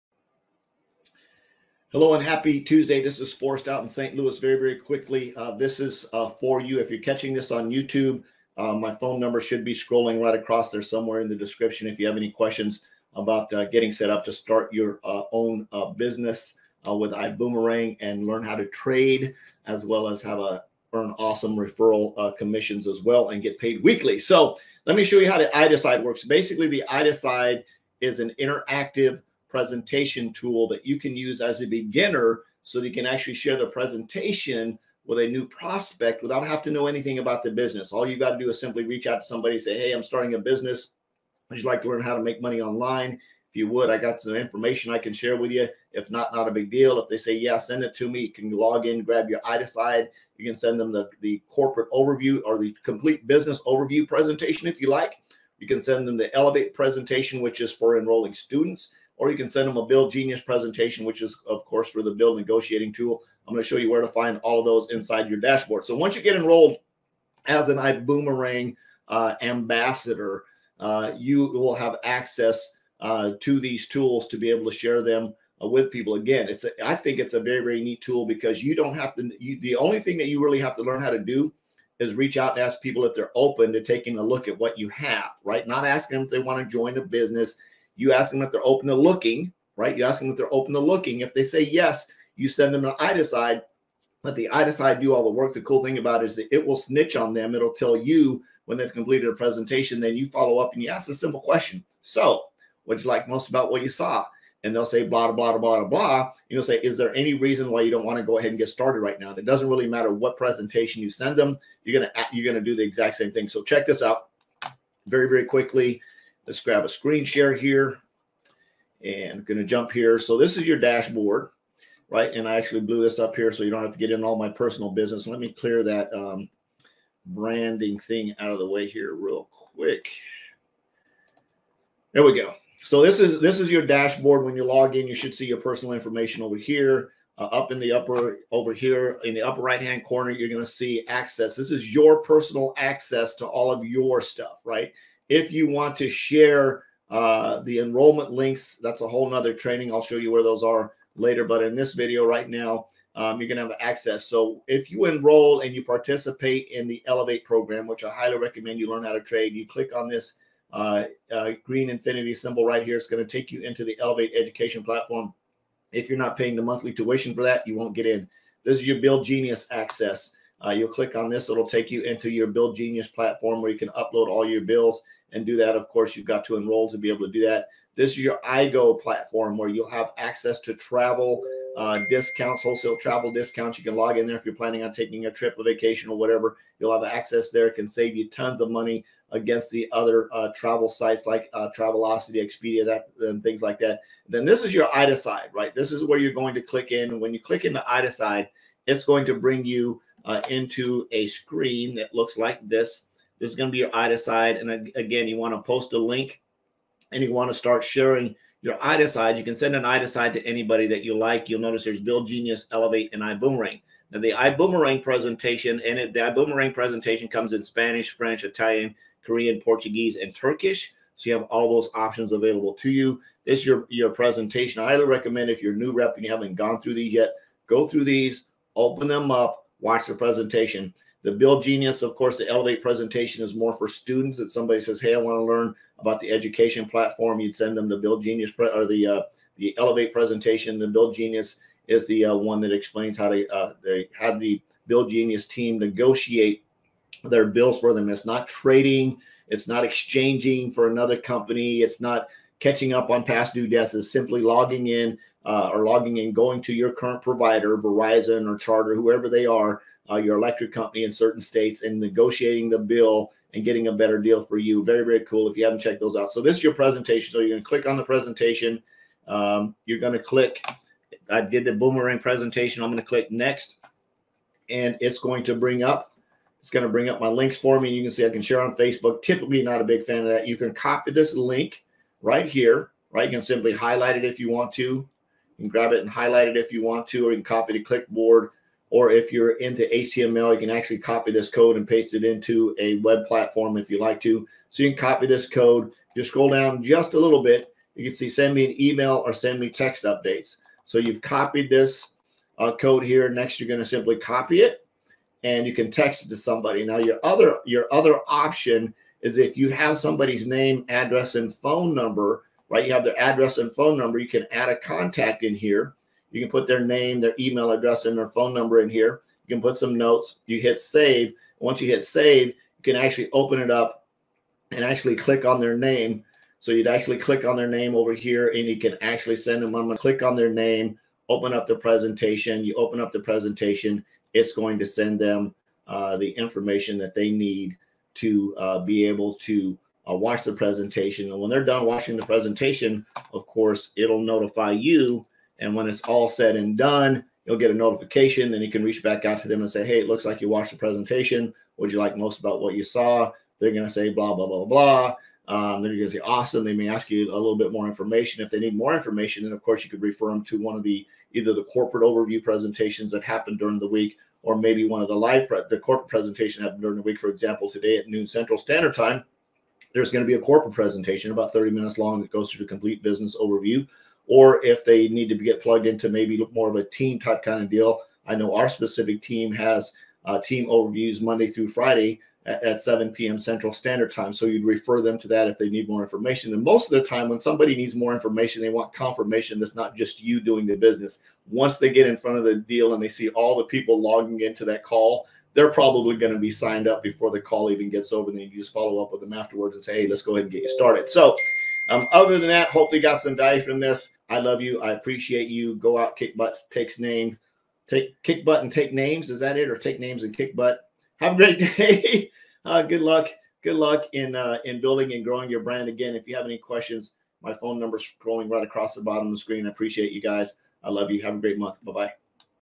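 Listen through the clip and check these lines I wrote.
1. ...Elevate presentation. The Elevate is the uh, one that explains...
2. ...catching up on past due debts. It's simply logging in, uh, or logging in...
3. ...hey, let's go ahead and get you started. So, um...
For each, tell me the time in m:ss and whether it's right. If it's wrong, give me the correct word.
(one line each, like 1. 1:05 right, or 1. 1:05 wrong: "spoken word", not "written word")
1. 3:59 wrong: "BillGenius", not "Elevate"
2. 4:12 right
3. 6:40 right.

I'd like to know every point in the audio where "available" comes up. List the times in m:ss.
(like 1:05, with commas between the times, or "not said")
3:42.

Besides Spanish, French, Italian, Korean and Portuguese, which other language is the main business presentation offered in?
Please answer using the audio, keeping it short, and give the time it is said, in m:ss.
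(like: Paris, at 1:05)
Turkish, at 3:40.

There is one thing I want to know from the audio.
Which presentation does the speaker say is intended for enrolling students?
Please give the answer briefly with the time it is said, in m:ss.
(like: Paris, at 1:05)
ELLEV8, at 0:56.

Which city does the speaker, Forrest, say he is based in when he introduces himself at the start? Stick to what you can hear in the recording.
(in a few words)
St. Louis.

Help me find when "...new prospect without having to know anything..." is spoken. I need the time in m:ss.
0:35.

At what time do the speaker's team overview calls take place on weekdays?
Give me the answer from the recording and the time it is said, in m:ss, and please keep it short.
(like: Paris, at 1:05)
7 p.m. Central, at 6:22.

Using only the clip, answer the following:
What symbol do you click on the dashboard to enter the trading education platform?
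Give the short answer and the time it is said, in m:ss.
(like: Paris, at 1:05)
green infinity symbol, at 2:41.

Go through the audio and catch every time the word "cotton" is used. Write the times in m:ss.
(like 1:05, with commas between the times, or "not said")
not said.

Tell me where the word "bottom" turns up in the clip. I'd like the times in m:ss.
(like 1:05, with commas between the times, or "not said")
6:59.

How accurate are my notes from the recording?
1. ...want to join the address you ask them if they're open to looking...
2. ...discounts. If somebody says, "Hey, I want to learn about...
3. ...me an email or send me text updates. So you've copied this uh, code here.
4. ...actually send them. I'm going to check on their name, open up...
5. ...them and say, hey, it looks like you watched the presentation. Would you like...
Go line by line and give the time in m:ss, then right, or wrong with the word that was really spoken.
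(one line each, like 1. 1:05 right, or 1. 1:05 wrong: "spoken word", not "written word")
1. 1:26 wrong: "business", not "address"
2. 3:53 wrong: "students", not "discounts"
3. 4:58 right
4. 5:29 wrong: "click", not "check"
5. 5:49 right.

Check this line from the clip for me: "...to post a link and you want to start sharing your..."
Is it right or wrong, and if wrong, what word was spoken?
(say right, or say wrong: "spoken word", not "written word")
right.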